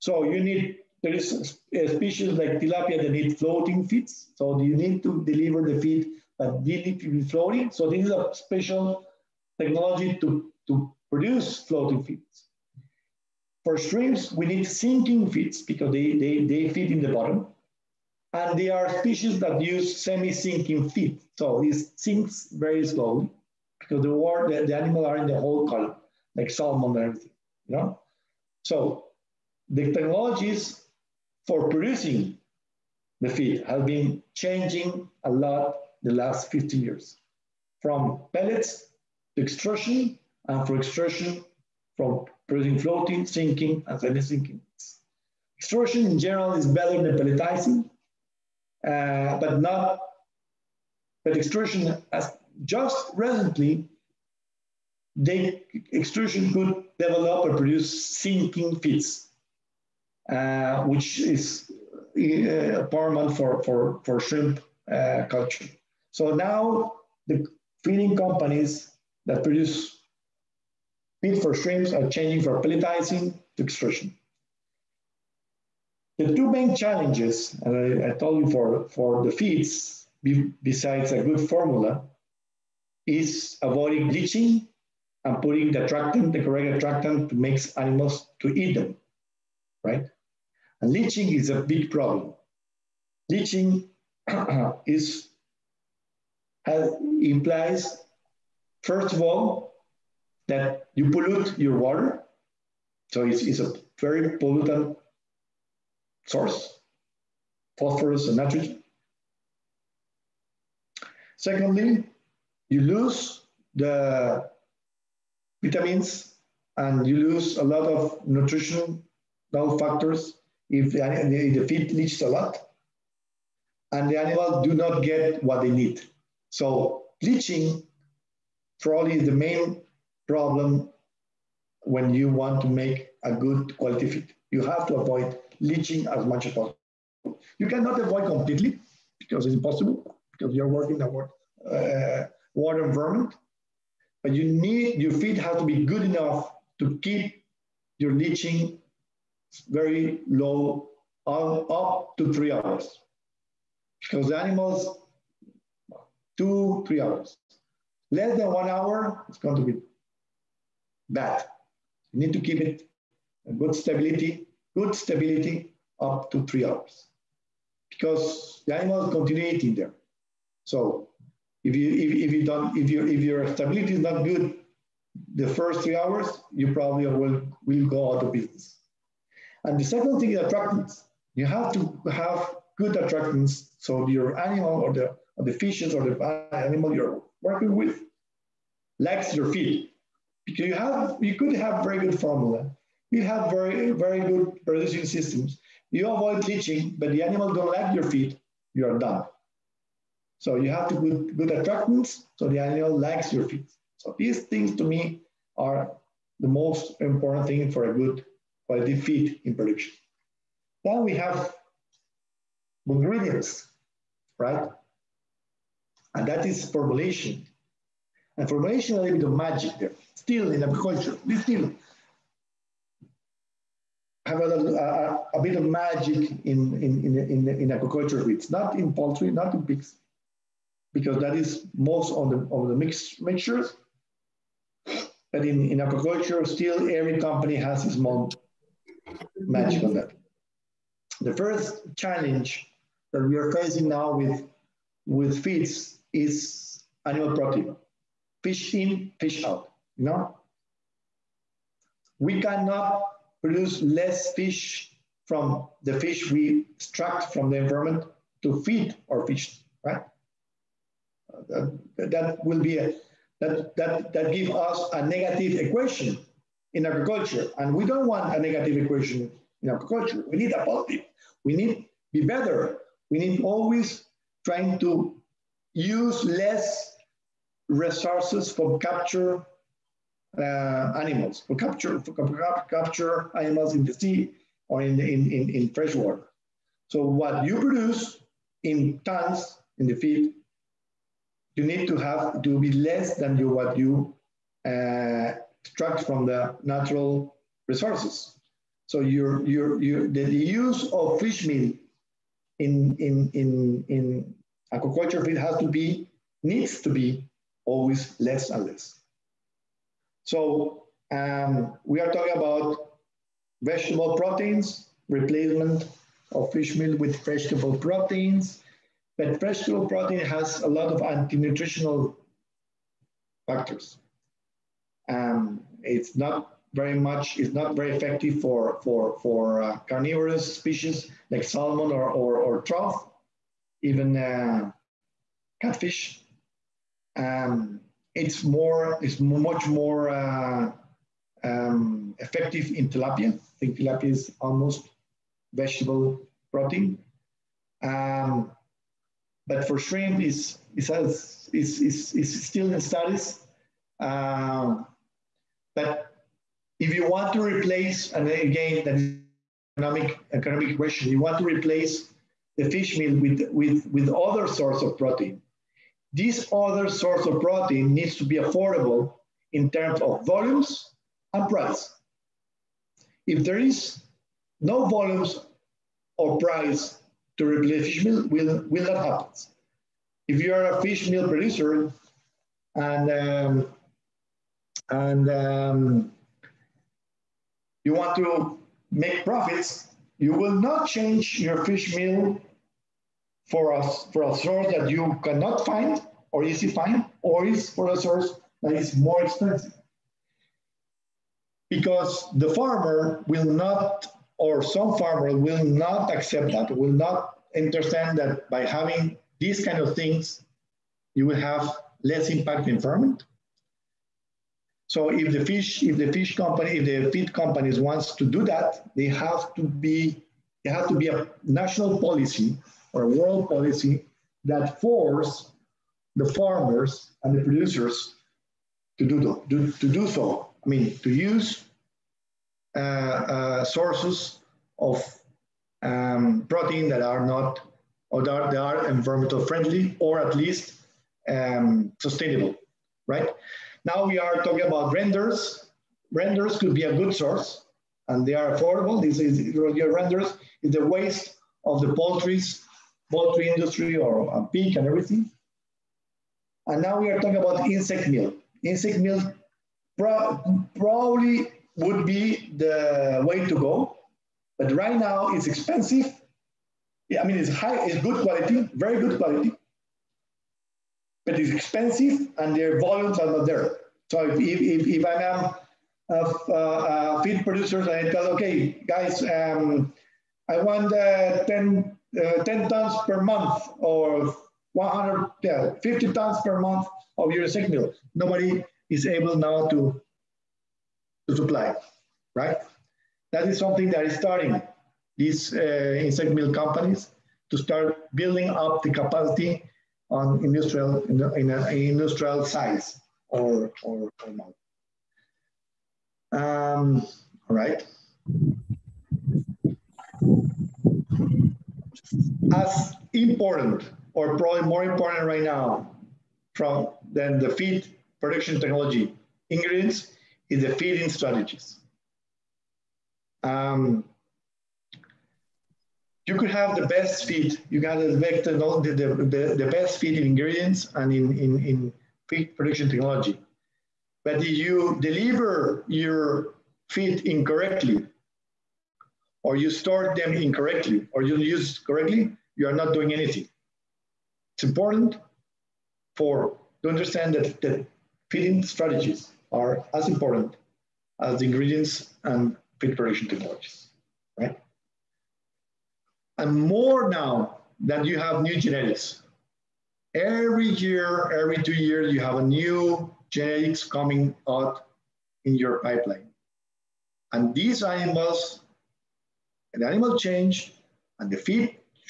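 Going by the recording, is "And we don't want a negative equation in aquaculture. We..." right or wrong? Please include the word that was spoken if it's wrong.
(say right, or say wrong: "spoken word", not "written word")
right.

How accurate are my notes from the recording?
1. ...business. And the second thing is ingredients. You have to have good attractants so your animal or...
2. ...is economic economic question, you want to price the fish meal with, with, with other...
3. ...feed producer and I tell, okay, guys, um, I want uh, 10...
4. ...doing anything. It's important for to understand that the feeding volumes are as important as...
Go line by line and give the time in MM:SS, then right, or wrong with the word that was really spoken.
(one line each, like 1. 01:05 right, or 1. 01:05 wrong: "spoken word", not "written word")
1. 02:58 wrong: "attractants", not "ingredients"
2. 05:58 wrong: "replace", not "price"
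3. 07:57 right
4. 09:02 wrong: "strategies", not "volumes".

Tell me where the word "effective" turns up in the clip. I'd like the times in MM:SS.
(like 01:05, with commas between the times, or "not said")
05:27, 05:42.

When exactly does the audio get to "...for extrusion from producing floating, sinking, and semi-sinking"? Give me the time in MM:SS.
00:40.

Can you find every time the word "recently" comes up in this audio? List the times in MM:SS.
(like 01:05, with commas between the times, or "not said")
00:53.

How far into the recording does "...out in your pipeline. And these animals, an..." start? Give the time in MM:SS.
09:24.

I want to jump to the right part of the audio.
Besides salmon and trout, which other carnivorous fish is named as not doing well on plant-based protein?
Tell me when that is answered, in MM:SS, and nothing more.
05:35.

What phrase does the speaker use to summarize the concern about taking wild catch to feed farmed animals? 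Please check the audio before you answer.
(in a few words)
Fish in, fish out.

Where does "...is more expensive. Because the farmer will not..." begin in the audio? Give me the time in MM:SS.
06:38.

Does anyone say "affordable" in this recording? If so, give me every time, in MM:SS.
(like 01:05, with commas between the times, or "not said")
06:08, 07:28.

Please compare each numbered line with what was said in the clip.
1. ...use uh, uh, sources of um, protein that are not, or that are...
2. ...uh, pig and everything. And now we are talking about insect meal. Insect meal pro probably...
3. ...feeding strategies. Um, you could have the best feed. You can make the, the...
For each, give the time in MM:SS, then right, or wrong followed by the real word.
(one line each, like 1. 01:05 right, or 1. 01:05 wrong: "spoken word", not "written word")
1. 07:11 right
2. 07:34 right
3. 08:40 right.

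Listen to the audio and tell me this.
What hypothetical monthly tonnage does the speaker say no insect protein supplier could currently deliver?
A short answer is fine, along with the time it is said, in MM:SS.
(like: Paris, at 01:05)
150 tons, at 08:04.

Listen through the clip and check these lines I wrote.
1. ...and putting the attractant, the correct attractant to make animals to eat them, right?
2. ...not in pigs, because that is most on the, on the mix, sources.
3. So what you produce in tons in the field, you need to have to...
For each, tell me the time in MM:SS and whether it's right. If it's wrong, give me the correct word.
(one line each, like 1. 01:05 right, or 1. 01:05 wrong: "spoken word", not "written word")
1. 01:25 right
2. 03:49 wrong: "mixtures", not "sources"
3. 04:46 right.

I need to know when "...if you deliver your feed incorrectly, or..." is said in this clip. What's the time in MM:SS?
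08:54.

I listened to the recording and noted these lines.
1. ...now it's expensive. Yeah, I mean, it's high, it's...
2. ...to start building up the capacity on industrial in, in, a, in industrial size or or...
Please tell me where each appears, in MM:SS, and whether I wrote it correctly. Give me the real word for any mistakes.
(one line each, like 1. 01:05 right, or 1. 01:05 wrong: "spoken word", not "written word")
1. 07:44 right
2. 08:17 right.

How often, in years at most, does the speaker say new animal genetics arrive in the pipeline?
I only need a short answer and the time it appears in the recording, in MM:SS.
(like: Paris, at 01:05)
2 years, at 09:21.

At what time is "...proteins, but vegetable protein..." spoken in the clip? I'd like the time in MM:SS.
05:17.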